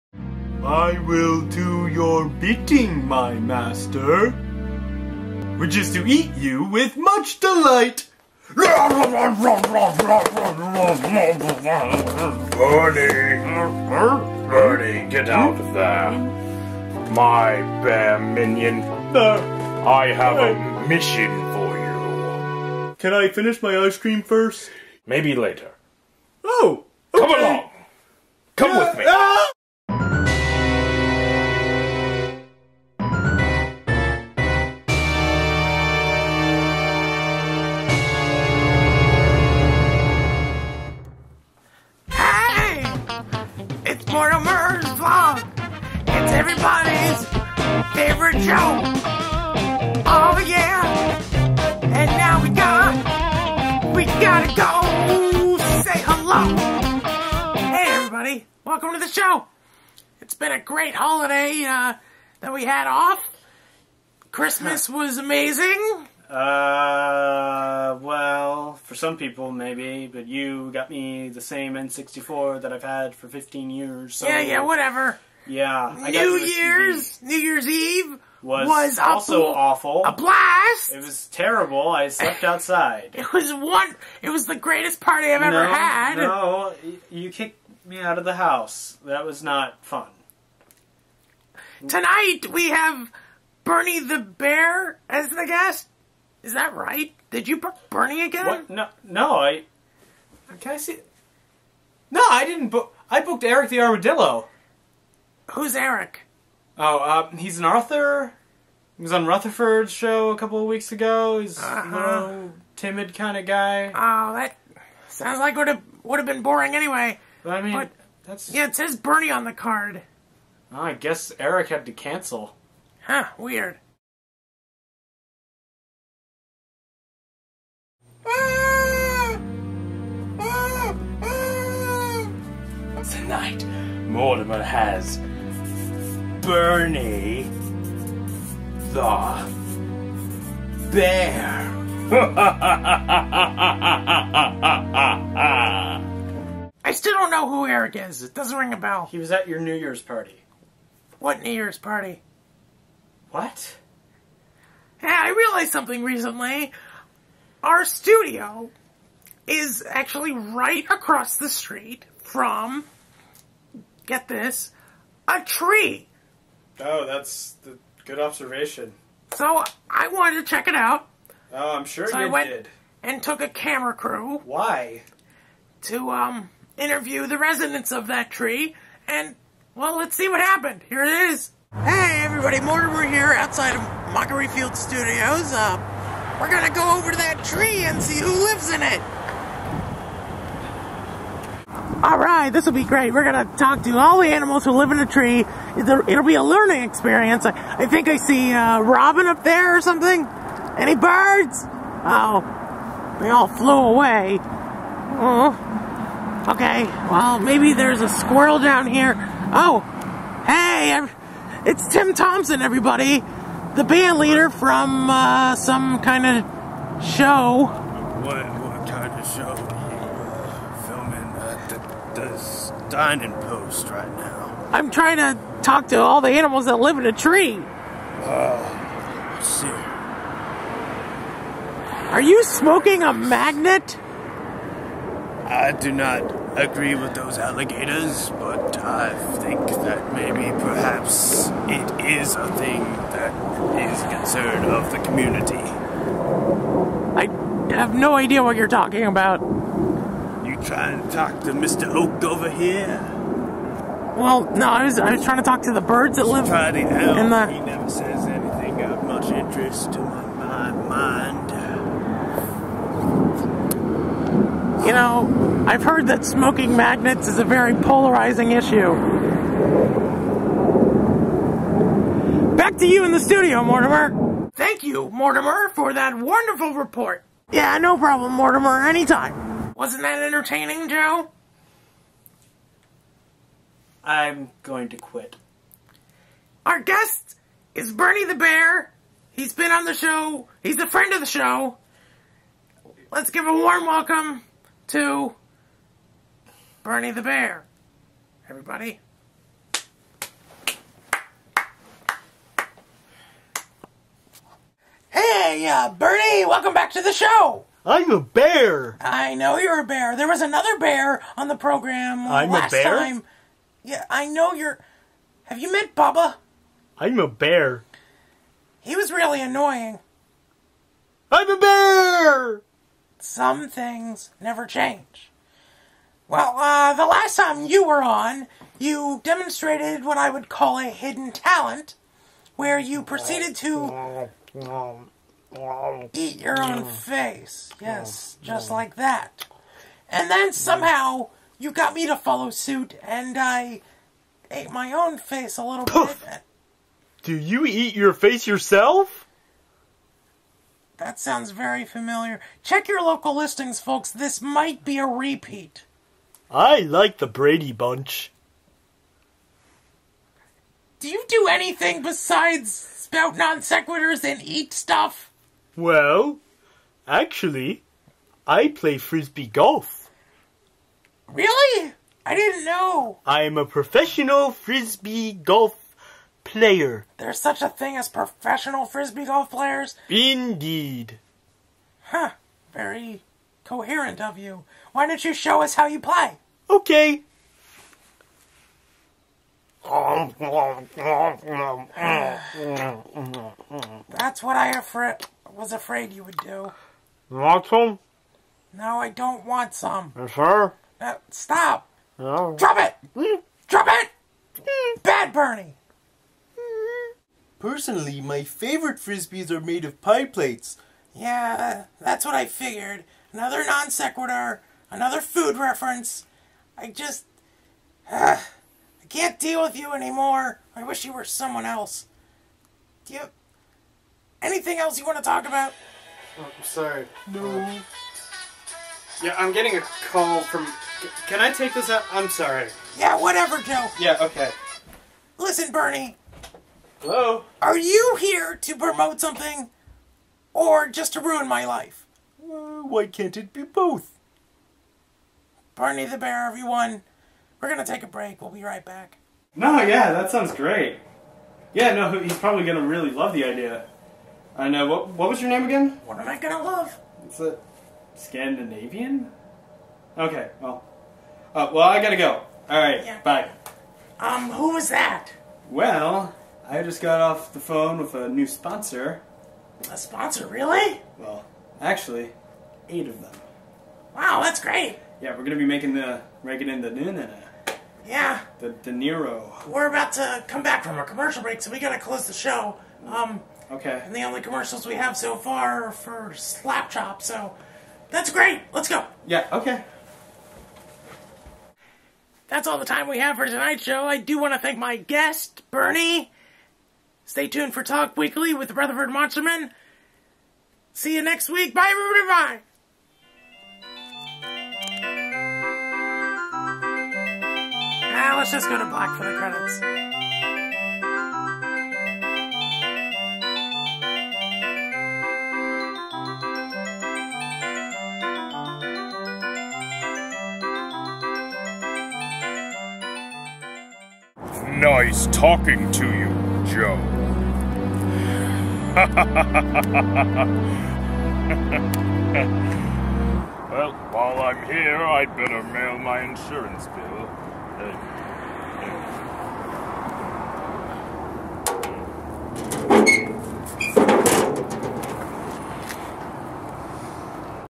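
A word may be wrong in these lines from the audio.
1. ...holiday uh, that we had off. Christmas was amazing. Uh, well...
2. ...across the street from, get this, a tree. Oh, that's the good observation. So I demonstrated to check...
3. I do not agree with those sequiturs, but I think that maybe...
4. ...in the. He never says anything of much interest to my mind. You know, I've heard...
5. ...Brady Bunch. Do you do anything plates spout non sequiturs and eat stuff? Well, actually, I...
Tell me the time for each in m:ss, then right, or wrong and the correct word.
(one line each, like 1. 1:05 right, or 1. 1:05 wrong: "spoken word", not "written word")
1. 1:00 right
2. 2:40 wrong: "wanted", not "demonstrated"
3. 3:55 wrong: "alligators", not "sequiturs"
4. 4:16 right
5. 5:57 wrong: "besides", not "plates".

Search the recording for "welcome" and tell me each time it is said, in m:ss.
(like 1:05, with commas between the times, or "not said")
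0:58, 4:53, 5:06.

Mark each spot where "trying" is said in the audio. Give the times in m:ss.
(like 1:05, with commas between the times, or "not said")
3:44, 4:10, 4:15.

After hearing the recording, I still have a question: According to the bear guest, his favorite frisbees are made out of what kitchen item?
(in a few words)
Pie plates.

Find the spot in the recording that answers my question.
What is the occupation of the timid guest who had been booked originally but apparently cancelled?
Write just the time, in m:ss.
1:47.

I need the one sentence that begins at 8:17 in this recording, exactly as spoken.
Stay tuned for Talk Weekly with Rutherford Monsterman.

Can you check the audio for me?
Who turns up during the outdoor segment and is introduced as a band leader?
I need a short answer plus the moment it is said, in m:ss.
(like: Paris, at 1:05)
Tim Thompson, at 3:31.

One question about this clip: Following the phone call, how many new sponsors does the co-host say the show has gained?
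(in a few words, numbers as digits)
8.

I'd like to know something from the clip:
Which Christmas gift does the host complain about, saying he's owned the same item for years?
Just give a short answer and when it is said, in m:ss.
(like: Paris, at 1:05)
N64, at 1:11.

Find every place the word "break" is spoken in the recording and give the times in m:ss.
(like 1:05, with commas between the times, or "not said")
7:28, 8:01.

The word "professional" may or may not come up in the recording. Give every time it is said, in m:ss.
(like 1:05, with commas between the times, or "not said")
6:13, 6:18.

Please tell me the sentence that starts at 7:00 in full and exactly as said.
I wish you were someone else.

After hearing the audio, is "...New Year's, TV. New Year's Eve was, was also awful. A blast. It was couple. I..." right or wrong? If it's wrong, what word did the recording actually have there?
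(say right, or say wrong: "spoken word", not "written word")
wrong: "terrible", not "couple".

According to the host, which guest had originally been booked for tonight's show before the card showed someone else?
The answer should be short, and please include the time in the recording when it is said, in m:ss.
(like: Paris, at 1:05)
Eric the Armadillo, at 1:43.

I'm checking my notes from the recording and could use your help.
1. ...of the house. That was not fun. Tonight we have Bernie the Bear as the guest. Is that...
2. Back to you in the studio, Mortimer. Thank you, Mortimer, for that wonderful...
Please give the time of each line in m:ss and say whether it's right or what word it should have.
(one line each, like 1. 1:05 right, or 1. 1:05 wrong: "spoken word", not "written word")
1. 1:28 right
2. 4:32 right.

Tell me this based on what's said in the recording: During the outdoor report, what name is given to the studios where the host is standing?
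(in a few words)
Mockery Field Studios.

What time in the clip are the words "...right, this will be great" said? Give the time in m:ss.
3:12.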